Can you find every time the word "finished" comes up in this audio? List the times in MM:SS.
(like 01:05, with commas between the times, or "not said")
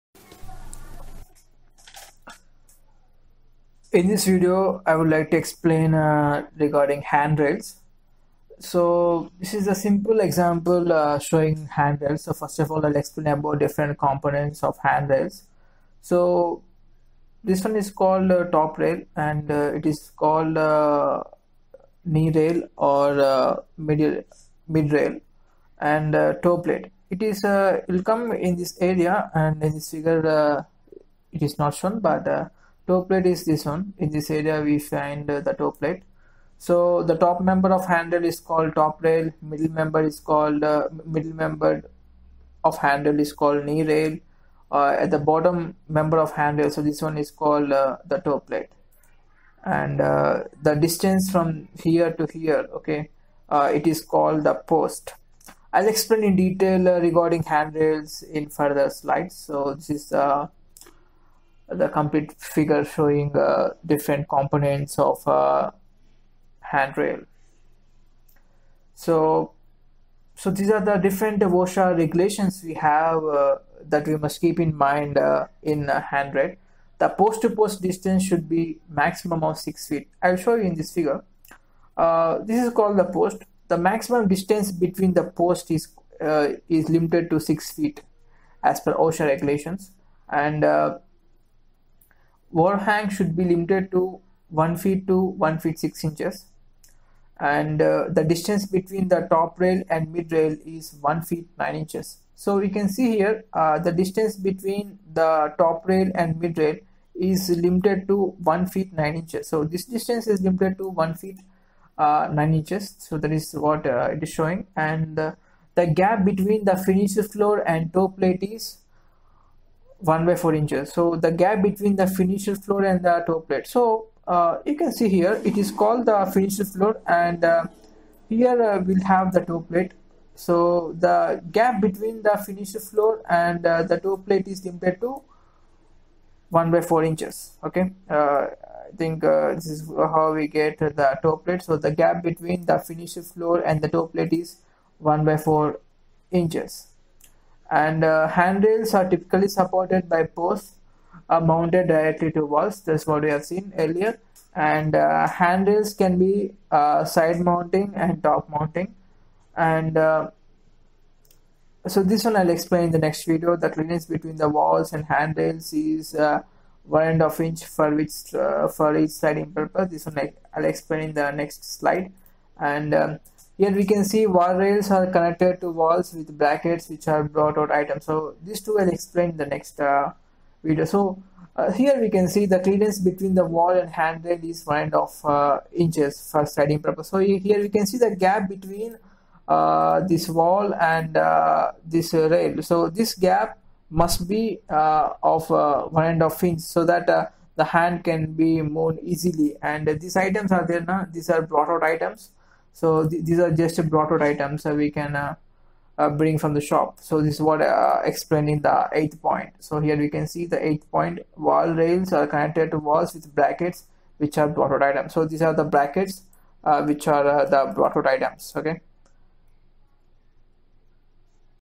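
01:56, 02:02, 02:06, 02:12, 02:22.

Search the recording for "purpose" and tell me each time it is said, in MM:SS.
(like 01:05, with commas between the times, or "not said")
02:49, 03:06.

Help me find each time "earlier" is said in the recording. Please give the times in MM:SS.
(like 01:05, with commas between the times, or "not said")
02:33.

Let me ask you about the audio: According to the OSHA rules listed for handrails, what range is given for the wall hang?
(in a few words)
1 foot to 1 foot 6 inches.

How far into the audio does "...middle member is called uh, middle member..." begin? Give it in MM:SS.
00:39.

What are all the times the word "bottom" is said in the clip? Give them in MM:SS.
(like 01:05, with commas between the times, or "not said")
00:45.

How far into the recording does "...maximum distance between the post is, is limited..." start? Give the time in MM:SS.
01:23.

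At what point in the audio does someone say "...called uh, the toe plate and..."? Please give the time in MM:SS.
00:47.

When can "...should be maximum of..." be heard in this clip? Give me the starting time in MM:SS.
01:18.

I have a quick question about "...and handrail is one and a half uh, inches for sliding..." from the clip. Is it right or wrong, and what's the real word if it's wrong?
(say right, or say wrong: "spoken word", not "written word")
right.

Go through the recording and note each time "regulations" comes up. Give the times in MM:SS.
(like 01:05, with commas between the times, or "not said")
01:11, 01:29.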